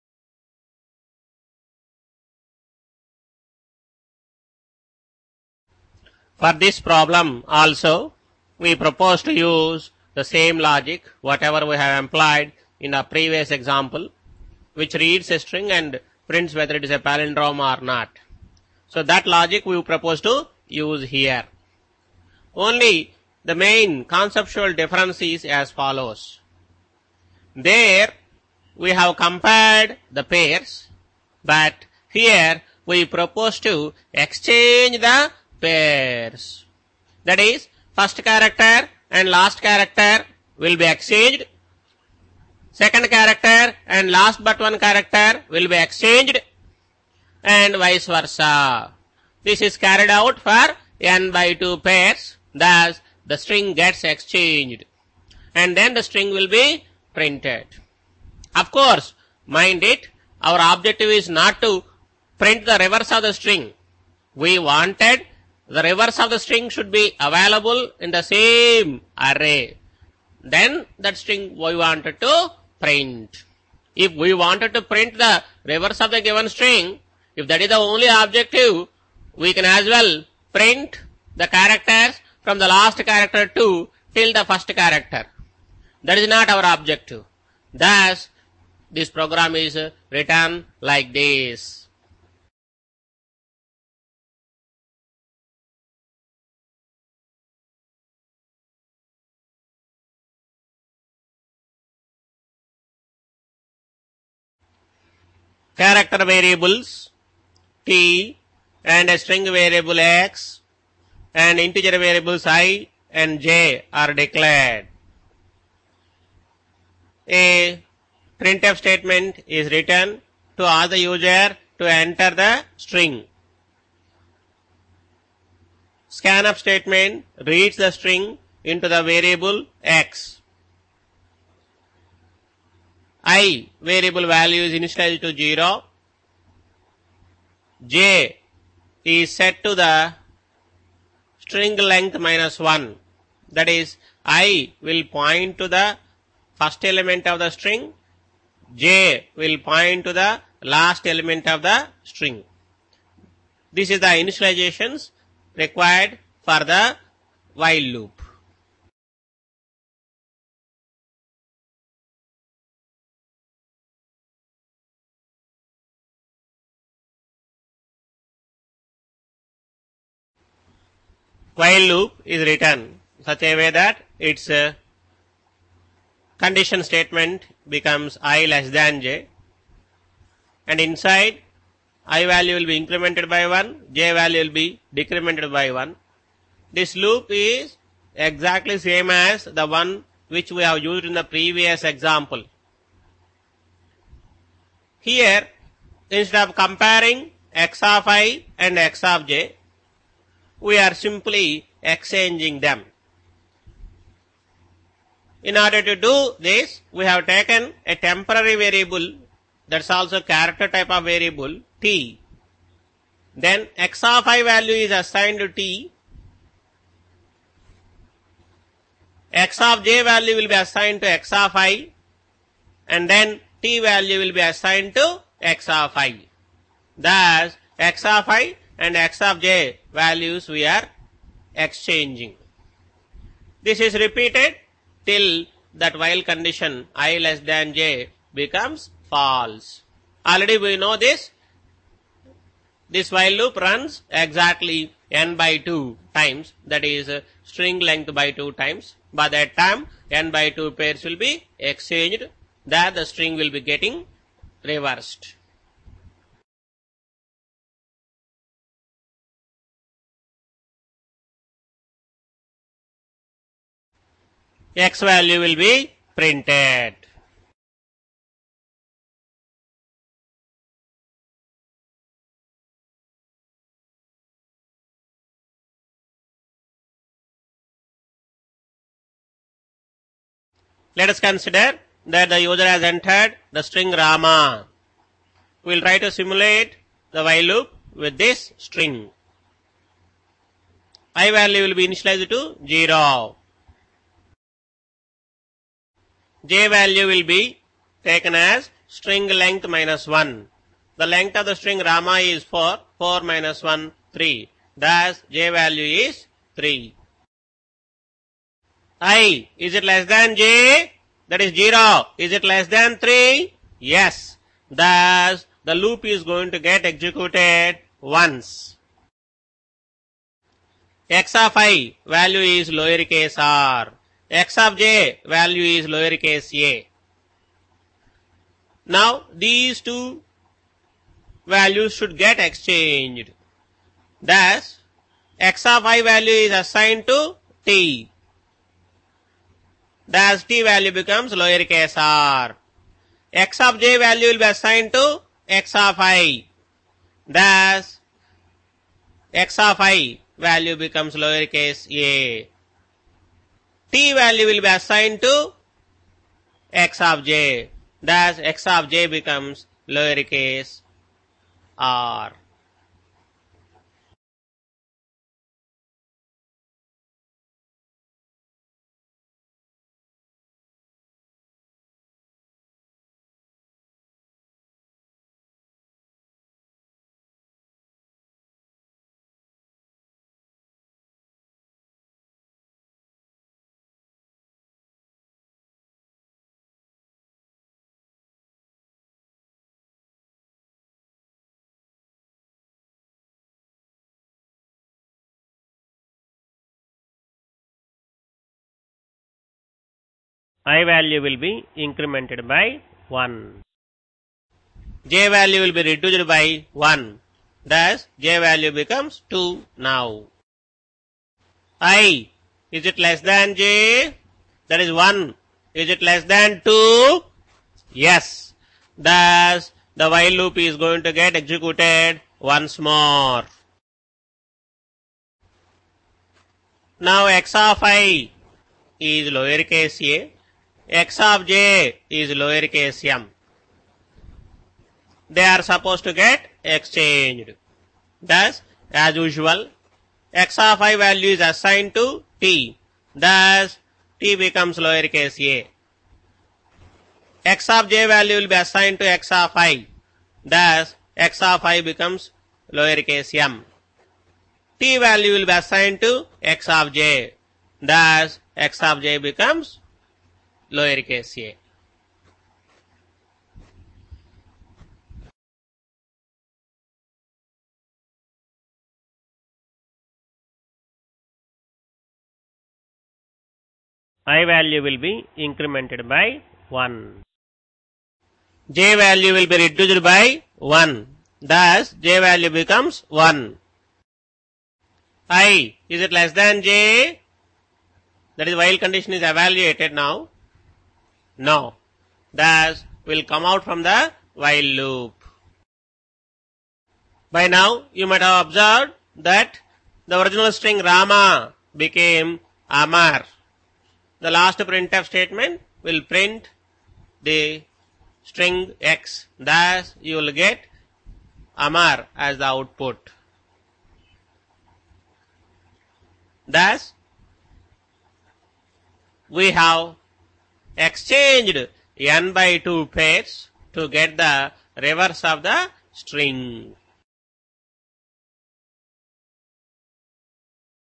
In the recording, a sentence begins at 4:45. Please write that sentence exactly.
We will try to simulate the while loop with this string.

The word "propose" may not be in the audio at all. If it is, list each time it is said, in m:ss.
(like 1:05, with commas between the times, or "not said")
0:08, 0:19, 0:33.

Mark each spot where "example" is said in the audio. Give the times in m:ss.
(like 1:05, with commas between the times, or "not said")
0:13, 3:11.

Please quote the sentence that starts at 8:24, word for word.
The last printf statement will print the string x.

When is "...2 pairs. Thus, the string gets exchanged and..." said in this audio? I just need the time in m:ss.
0:51.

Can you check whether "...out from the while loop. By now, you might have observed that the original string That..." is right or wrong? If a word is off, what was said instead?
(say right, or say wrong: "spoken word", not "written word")
wrong: "Rama", not "That".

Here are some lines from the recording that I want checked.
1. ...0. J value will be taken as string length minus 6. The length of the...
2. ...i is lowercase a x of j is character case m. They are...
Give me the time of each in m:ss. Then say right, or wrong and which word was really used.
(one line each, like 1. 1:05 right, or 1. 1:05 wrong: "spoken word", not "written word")
1. 4:52 wrong: "1", not "6"
2. 7:07 wrong: "lower", not "character".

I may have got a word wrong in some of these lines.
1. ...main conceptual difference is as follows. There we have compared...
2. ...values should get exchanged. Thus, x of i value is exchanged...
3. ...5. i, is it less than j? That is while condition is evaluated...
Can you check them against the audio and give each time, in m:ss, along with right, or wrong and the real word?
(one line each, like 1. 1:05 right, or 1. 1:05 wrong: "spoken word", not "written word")
1. 0:23 right
2. 5:31 wrong: "assigned", not "exchanged"
3. 8:03 wrong: "1", not "5".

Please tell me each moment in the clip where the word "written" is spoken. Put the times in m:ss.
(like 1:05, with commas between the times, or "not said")
1:30, 1:59, 2:52.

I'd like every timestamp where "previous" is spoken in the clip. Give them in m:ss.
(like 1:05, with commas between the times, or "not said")
0:13, 3:11.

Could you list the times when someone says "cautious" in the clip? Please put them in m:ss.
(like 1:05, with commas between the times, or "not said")
not said.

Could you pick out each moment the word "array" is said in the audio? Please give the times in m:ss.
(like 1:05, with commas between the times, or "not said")
1:09.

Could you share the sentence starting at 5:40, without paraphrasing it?
Thus, t value becomes lower case r.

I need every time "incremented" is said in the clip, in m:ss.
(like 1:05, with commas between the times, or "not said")
3:02, 6:41, 7:55.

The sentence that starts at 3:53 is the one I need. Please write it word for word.
This is repeated till that while condition i less than j becomes false.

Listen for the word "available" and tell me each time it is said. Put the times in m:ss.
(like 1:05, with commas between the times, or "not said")
1:07.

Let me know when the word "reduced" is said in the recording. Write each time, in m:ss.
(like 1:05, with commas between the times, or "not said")
6:45, 7:59.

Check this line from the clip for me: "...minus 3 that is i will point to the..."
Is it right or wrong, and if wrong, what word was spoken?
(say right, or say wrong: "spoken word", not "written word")
wrong: "1", not "3".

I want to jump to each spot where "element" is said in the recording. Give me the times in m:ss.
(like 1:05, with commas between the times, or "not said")
2:26, 2:31.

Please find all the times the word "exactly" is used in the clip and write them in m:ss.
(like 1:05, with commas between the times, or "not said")
3:08, 4:04.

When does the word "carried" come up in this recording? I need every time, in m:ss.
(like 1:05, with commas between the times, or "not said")
0:49.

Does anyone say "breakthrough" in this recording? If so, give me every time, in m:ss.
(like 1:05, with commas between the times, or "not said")
not said.